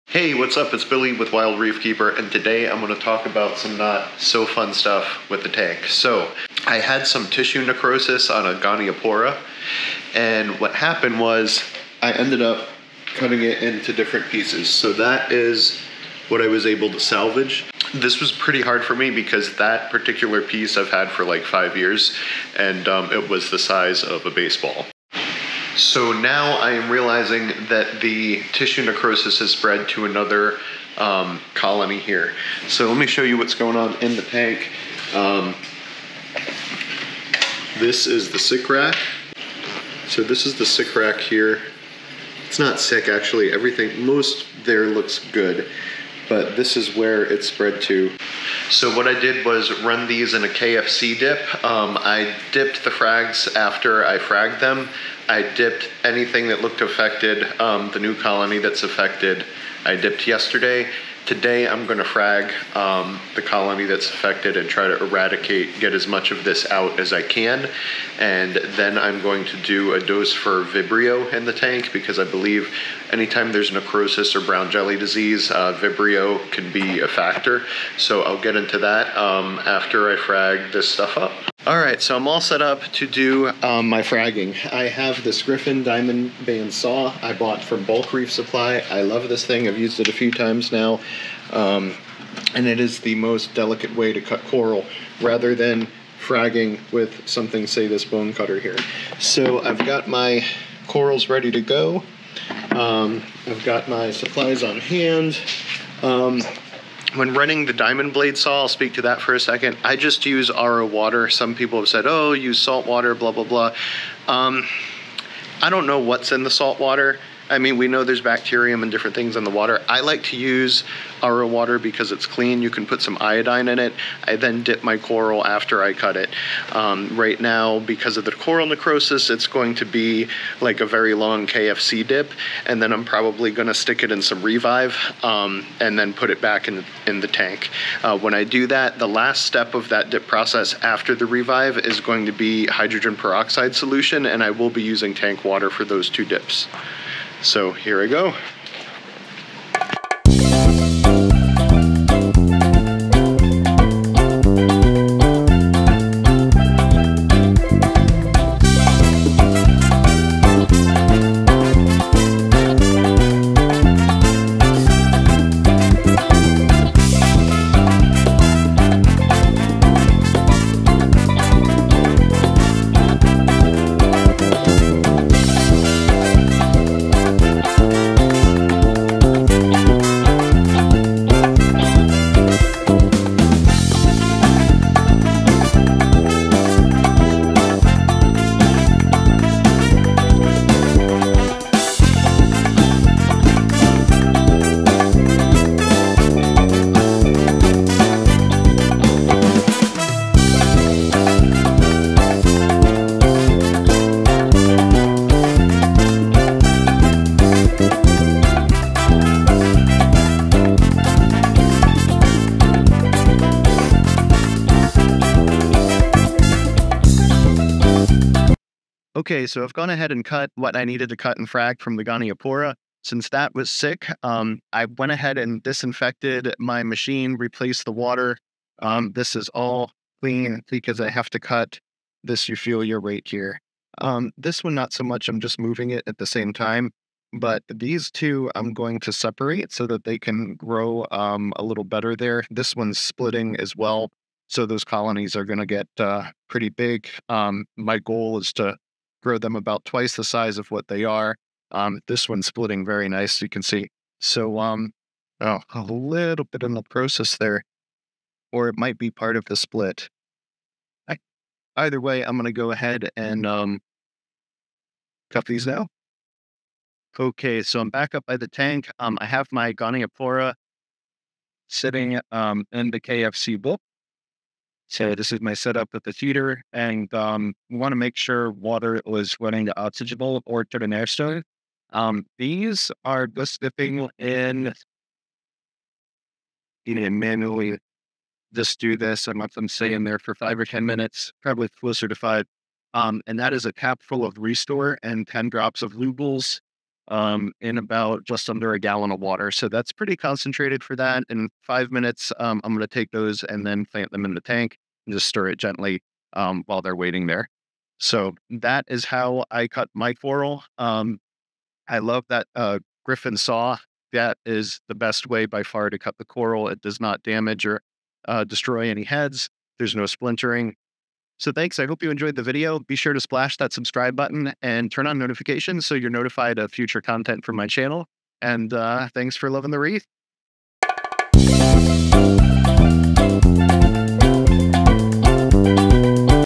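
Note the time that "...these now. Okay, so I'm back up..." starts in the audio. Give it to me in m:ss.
4:25.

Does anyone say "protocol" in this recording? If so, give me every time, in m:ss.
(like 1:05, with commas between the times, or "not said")
not said.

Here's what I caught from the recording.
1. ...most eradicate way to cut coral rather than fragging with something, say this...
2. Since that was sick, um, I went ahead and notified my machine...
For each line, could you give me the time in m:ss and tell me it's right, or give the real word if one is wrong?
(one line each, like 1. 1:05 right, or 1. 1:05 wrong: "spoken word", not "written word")
1. 1:33 wrong: "delicate", not "eradicate"
2. 3:43 wrong: "disinfected", not "notified".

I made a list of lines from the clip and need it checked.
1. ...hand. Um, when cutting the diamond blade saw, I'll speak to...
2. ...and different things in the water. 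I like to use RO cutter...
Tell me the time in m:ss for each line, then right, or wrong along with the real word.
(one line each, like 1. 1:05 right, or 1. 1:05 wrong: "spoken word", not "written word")
1. 1:44 wrong: "running", not "cutting"
2. 1:58 wrong: "water", not "cutter".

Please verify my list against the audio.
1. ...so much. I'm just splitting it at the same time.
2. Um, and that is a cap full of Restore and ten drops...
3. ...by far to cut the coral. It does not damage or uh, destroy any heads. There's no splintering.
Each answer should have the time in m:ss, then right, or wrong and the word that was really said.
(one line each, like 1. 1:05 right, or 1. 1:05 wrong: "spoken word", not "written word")
1. 3:54 wrong: "moving", not "splitting"
2. 4:52 right
3. 5:15 right.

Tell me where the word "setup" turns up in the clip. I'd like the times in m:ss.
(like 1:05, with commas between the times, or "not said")
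4:35.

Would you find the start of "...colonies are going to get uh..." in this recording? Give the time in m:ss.
4:04.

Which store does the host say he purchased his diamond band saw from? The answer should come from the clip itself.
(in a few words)
Bulk Reef Supply.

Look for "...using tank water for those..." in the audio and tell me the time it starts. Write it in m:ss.
2:24.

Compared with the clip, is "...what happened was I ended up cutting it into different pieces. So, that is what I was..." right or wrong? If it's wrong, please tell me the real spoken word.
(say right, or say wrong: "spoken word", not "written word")
right.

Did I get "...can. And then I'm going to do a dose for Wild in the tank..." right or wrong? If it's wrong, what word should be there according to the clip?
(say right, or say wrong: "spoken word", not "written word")
wrong: "Vibrio", not "Wild".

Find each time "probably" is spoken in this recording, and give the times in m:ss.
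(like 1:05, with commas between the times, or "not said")
2:13, 4:51.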